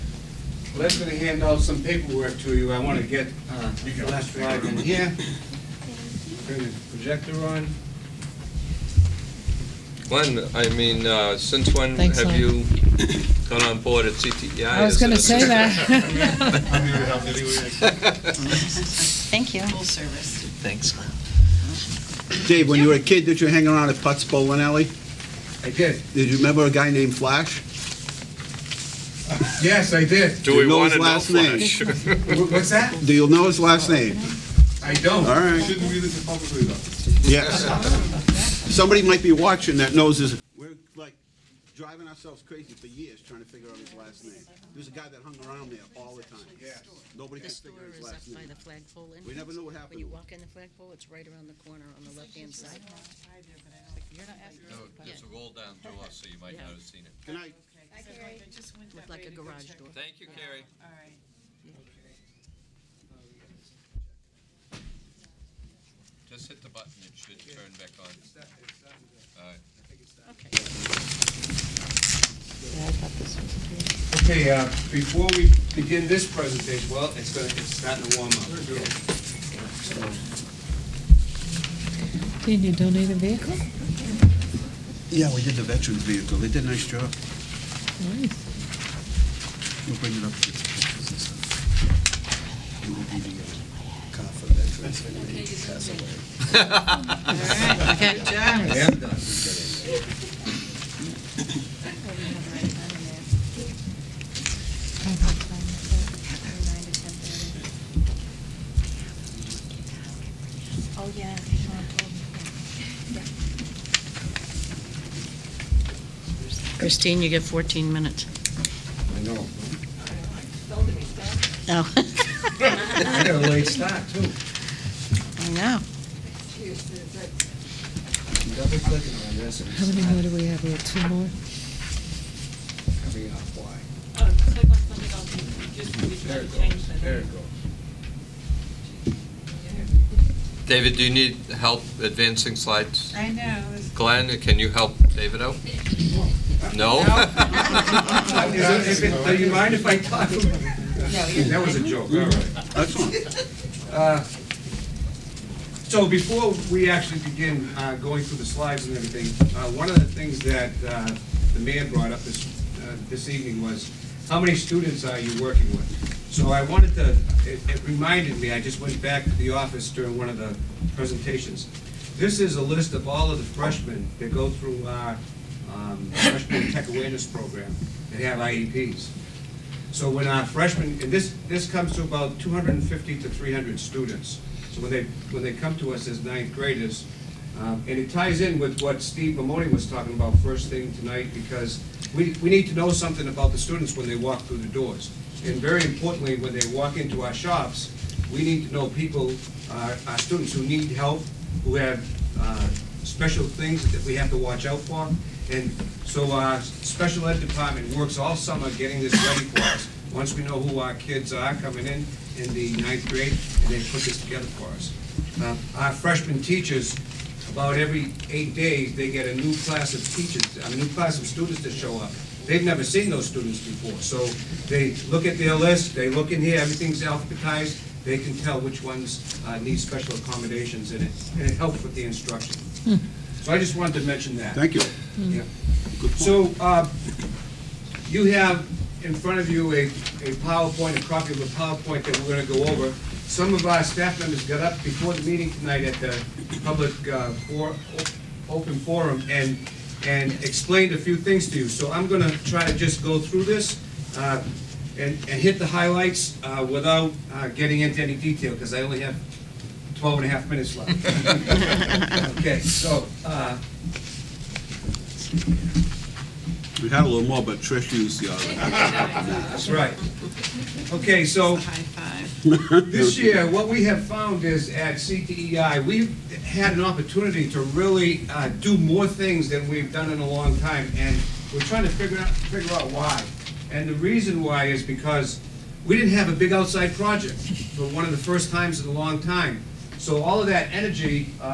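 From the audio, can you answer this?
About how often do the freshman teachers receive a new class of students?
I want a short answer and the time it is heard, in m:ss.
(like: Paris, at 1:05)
every 8 days, at 3:37.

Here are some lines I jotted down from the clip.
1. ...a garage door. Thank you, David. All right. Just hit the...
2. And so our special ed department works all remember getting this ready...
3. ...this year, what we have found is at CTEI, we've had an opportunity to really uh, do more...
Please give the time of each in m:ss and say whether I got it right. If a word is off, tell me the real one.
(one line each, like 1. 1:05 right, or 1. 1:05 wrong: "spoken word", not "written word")
1. 0:59 wrong: "Carrie", not "David"
2. 3:25 wrong: "summer", not "remember"
3. 4:32 right.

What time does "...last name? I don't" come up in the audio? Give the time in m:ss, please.
0:33.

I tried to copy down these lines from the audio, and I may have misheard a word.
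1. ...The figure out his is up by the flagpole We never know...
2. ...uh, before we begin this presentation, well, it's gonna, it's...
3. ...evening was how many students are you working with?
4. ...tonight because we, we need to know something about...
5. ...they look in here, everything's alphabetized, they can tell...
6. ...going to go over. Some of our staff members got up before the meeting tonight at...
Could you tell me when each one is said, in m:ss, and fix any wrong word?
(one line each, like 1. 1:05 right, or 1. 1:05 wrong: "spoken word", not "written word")
1. 0:47 right
2. 1:14 right
3. 2:43 right
4. 3:10 right
5. 3:45 right
6. 4:02 right.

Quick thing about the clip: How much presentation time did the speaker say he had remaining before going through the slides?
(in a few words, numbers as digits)
12 and a half minutes.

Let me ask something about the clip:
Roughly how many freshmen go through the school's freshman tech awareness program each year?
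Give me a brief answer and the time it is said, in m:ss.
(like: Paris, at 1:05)
250 to 300, at 3:02.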